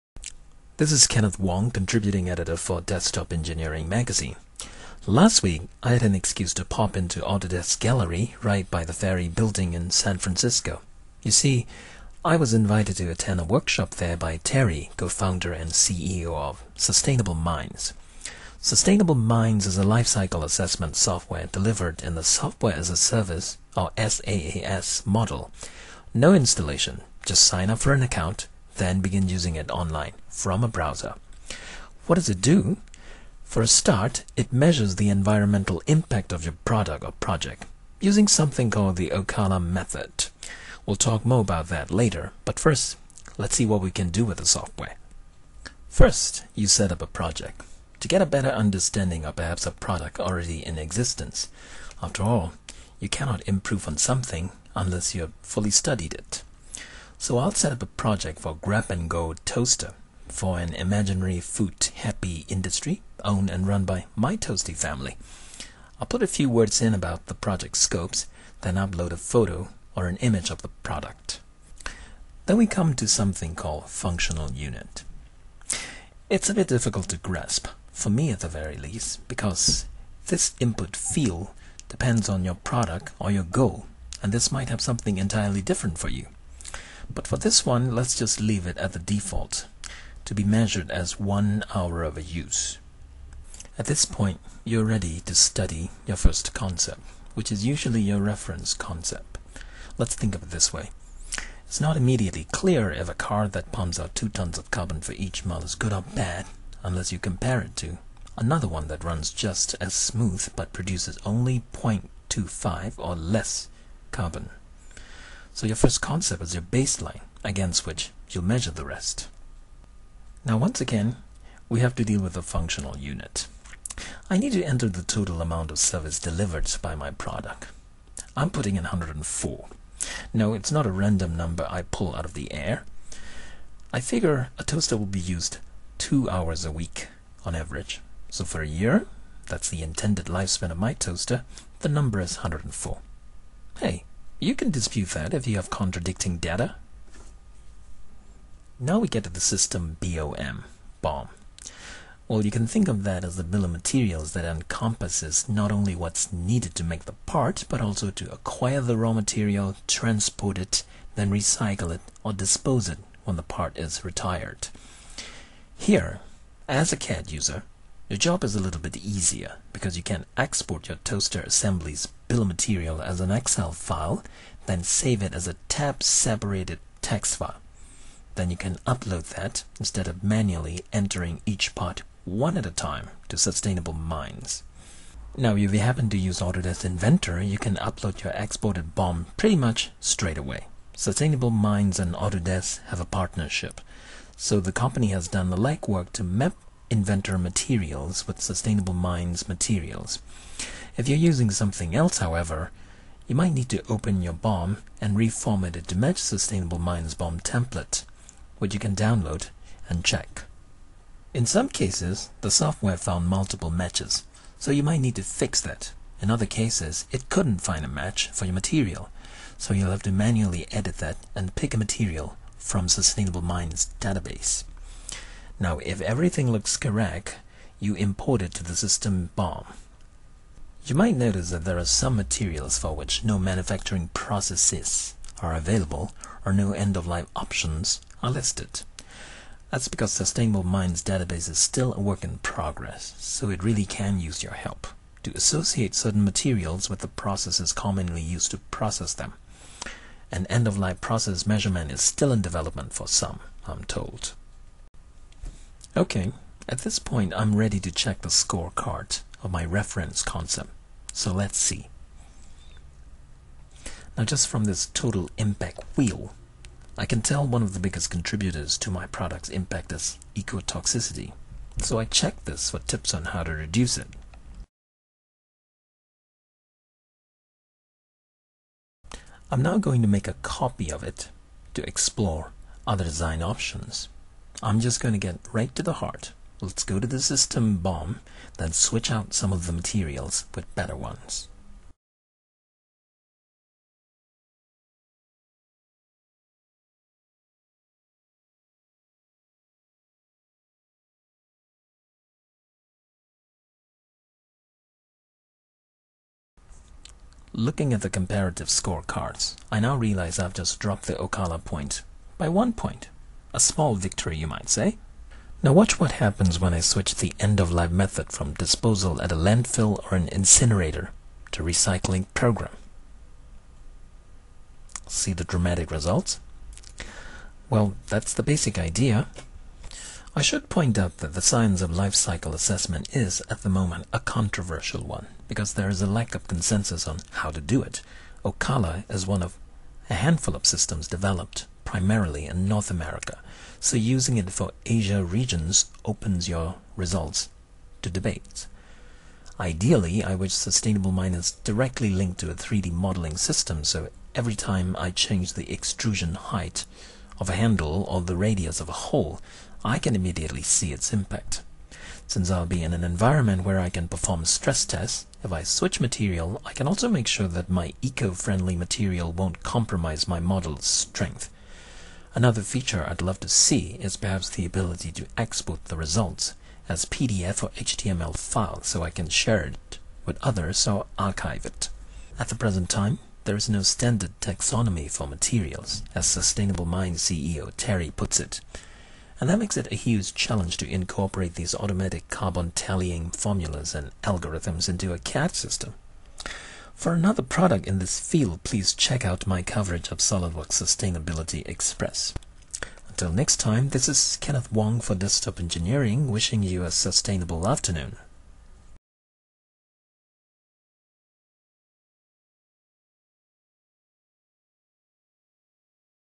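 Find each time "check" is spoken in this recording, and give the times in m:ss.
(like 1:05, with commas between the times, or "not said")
3:30, 4:17, 4:32, 6:38.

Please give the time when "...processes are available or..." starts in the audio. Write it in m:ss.
3:54.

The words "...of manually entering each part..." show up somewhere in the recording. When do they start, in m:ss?
3:00.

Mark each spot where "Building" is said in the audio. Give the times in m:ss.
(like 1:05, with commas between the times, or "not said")
0:09.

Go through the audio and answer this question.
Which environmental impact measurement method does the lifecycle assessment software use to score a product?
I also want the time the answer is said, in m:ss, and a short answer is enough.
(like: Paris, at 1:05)
Okala method, at 0:39.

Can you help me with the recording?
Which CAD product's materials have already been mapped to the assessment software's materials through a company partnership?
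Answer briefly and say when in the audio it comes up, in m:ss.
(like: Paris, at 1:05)
Autodesk Inventor, at 3:06.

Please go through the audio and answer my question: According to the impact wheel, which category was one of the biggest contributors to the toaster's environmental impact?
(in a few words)
Ecotoxicity.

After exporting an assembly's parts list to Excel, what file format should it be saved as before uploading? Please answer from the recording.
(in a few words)
tab-separated text file.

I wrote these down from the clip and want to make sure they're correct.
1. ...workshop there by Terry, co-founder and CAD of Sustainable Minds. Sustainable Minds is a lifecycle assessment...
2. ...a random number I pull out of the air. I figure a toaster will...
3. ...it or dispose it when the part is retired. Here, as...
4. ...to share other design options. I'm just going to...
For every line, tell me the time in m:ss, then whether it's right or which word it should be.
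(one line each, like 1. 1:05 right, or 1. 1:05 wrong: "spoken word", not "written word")
1. 0:13 wrong: "CEO", not "CAD"
2. 2:10 right
3. 2:41 right
4. 4:41 wrong: "explore", not "share".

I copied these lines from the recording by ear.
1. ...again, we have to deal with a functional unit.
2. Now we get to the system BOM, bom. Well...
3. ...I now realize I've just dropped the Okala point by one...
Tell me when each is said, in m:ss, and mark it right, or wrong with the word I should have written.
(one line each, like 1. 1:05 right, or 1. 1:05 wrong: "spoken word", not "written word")
1. 2:00 right
2. 2:28 right
3. 5:09 right.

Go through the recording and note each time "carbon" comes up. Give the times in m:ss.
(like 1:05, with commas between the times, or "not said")
1:44, 1:54, 6:32.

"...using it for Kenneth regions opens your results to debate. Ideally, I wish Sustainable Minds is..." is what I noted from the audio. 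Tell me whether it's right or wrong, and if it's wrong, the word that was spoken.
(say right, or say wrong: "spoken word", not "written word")
wrong: "Asia", not "Kenneth".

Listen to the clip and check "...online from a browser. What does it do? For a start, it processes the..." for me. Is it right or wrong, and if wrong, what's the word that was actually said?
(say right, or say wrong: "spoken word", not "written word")
wrong: "measures", not "processes".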